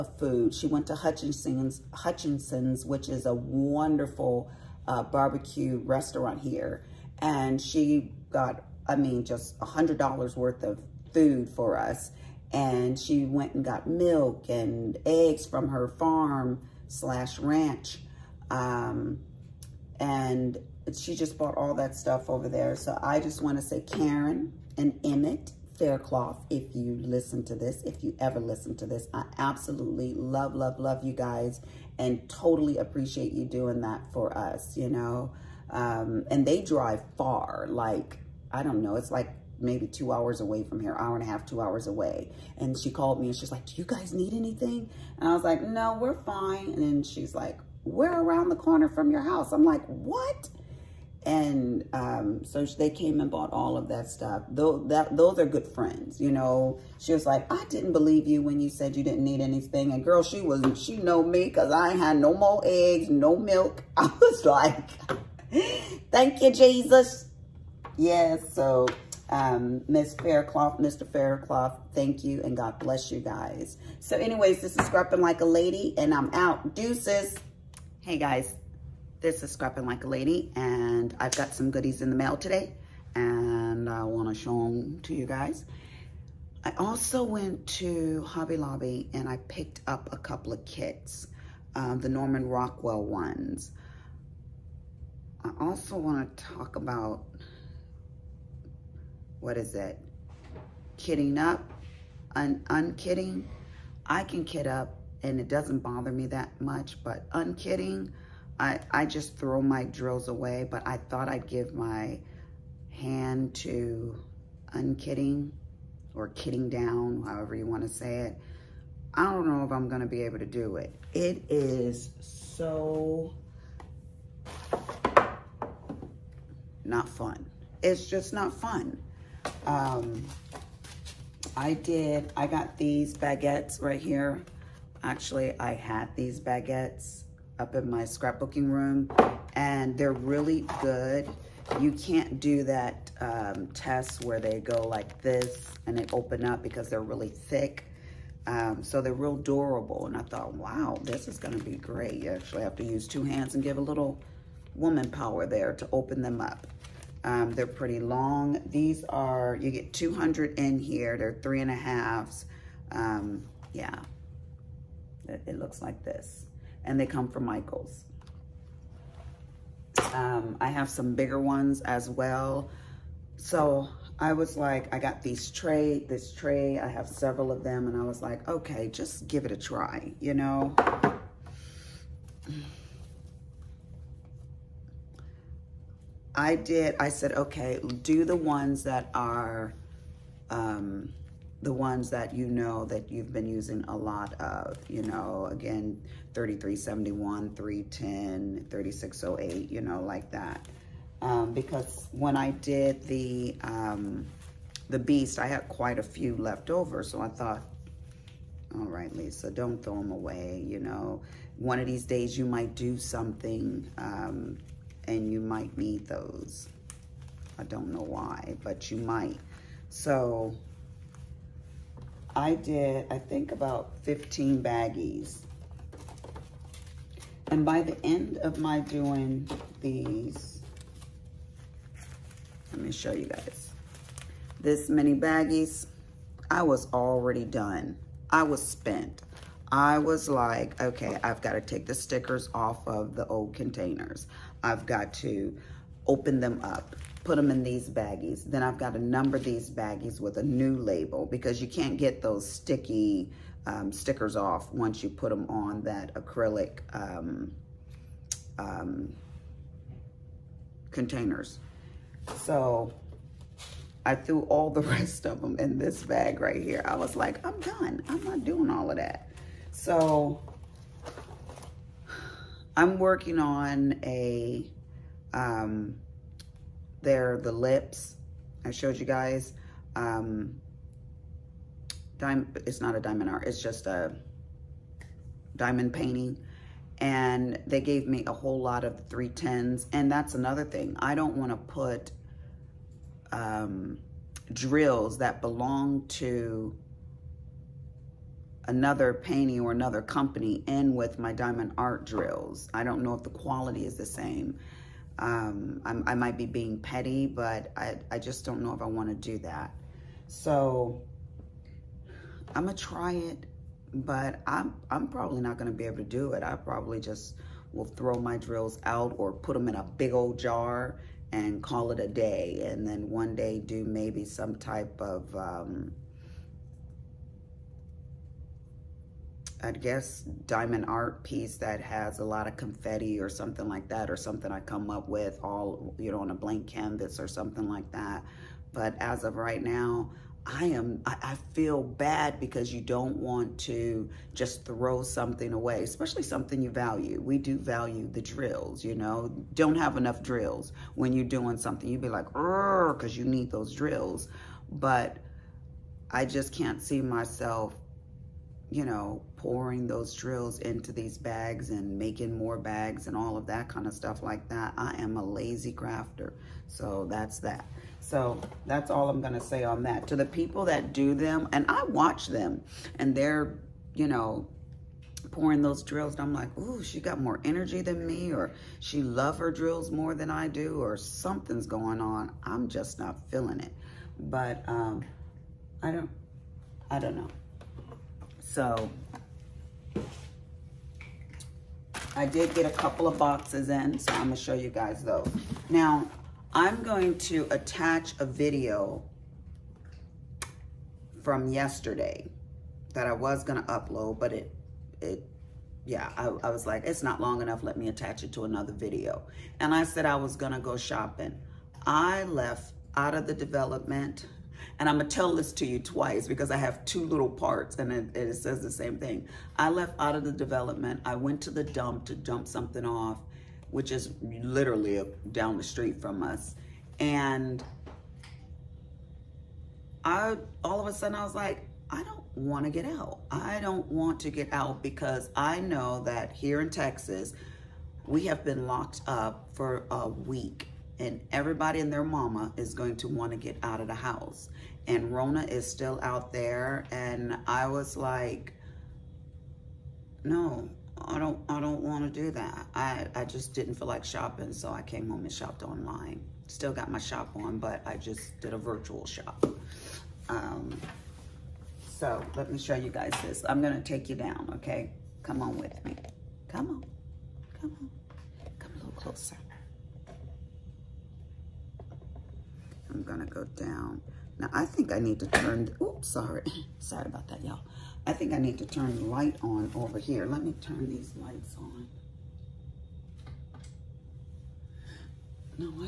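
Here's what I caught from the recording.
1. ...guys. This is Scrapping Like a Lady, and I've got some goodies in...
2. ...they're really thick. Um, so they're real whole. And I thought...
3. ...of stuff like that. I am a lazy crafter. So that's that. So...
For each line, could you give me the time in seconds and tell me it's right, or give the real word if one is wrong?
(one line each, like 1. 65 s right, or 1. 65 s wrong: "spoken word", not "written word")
1. 78 s right
2. 146 s wrong: "durable", not "whole"
3. 363 s right.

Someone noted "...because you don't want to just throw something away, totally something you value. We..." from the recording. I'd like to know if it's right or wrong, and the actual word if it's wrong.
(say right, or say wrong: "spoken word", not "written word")
wrong: "especially", not "totally".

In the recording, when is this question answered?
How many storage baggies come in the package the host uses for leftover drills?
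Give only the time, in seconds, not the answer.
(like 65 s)
159 s.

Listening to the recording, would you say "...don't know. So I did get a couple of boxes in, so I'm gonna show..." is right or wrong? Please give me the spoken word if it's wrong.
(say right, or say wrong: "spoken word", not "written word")
right.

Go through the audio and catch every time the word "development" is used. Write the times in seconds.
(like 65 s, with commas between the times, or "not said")
413 s, 420 s.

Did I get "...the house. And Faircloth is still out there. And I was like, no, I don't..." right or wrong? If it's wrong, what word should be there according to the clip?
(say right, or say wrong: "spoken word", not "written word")
wrong: "Rona", not "Faircloth".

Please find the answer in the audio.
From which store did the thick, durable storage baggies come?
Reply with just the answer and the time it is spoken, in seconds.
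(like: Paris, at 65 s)
Michaels, at 167 s.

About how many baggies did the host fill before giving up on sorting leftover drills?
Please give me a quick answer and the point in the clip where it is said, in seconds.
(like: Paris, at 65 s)
15, at 224 s.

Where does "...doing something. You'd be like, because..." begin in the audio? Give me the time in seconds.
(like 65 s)
351 s.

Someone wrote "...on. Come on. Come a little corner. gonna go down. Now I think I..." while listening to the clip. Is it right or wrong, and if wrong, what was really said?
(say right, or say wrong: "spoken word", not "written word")
wrong: "closer", not "corner".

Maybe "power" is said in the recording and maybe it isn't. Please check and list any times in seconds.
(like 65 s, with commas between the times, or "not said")
155 s.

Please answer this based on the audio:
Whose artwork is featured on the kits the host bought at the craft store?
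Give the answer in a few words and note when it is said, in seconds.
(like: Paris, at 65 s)
Norman Rockwell, at 92 s.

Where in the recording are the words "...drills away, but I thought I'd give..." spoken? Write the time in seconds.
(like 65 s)
109 s.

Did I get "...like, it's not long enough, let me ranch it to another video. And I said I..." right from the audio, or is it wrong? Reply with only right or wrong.
wrong.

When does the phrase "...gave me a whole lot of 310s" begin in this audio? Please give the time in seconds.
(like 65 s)
287 s.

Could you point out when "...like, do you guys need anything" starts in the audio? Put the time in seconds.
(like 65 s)
43 s.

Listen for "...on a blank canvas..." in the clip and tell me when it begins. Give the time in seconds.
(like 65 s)
336 s.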